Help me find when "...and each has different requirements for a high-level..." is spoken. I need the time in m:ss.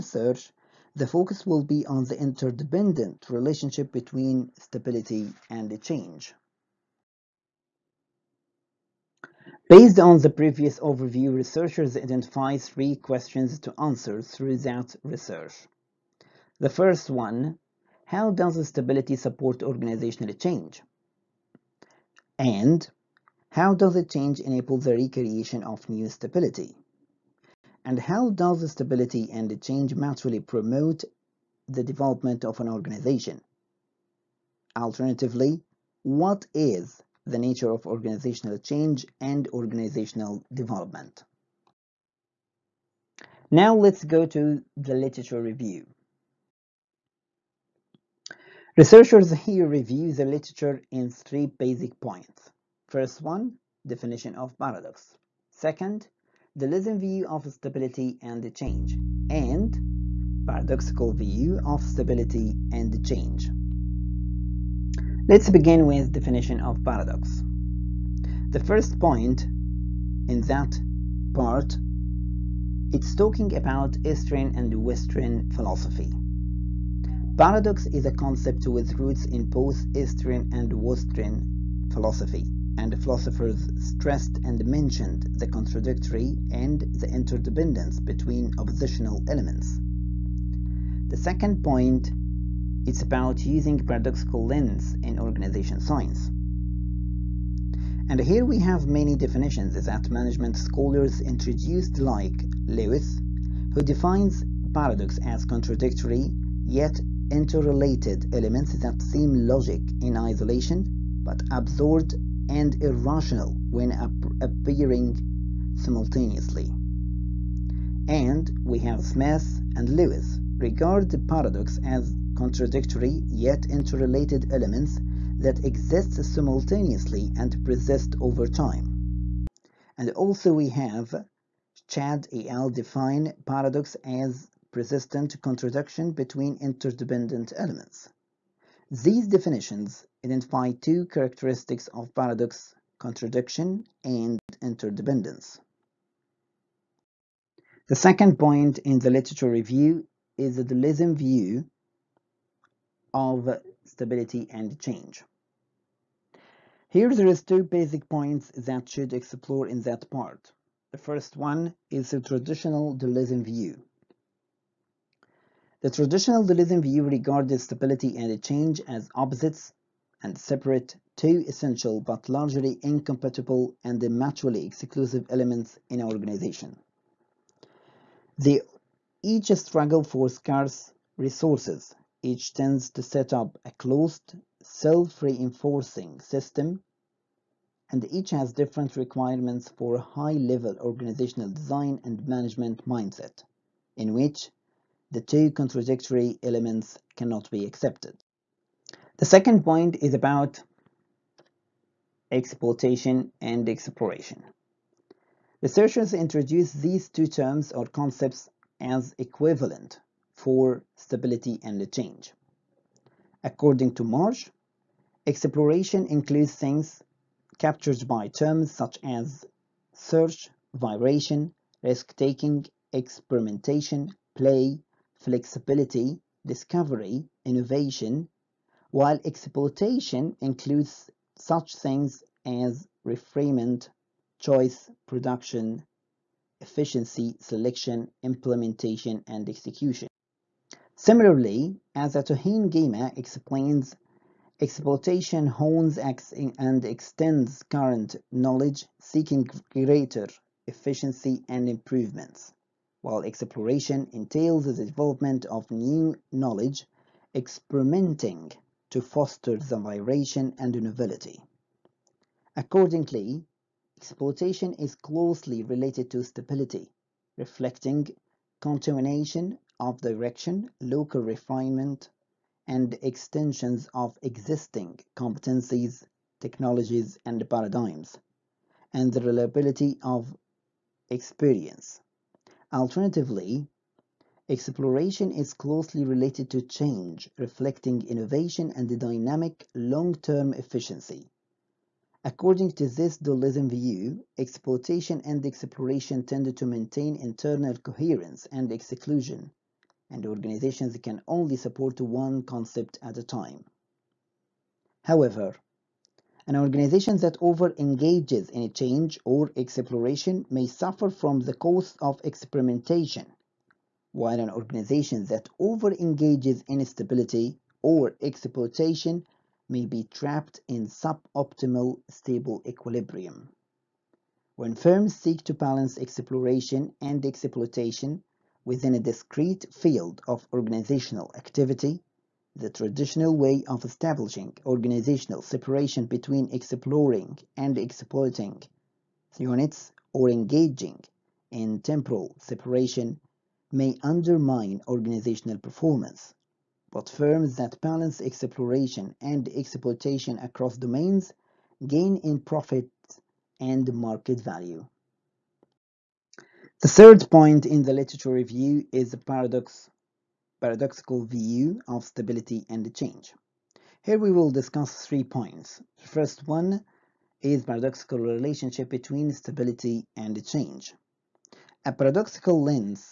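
3:07.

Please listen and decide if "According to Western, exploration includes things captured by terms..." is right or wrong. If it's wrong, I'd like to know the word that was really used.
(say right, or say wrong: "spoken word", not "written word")
wrong: "March", not "Western".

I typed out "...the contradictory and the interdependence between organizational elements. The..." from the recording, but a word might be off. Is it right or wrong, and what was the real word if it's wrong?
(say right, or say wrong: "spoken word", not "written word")
wrong: "oppositional", not "organizational".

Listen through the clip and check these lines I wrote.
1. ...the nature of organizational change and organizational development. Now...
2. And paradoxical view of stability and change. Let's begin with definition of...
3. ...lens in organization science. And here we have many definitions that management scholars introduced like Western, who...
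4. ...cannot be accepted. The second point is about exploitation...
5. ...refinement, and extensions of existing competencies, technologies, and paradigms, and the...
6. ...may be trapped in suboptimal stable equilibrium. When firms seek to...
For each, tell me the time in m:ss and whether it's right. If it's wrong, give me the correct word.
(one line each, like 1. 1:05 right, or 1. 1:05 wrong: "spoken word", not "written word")
1. 0:37 right
2. 0:59 right
3. 1:34 wrong: "Lewis", not "Western"
4. 3:17 right
5. 4:31 right
6. 5:19 right.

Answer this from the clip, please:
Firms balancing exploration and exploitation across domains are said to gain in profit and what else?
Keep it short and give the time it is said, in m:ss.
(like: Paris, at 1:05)
market value, at 5:53.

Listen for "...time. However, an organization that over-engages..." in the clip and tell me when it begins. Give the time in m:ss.
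5:03.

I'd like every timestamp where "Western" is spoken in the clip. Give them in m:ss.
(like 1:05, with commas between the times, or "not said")
1:14, 1:20.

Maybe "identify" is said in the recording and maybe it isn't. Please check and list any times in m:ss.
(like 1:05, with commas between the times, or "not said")
0:11, 2:20.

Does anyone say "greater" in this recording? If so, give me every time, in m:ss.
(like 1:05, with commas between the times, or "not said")
4:09.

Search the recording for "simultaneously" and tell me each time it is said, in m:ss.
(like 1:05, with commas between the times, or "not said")
1:55, 2:06.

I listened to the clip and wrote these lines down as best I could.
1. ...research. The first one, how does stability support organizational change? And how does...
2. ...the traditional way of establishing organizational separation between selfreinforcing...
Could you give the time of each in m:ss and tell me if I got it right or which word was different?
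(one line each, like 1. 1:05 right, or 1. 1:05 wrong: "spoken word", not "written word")
1. 0:15 right
2. 5:32 wrong: "exploring", not "selfreinforcing".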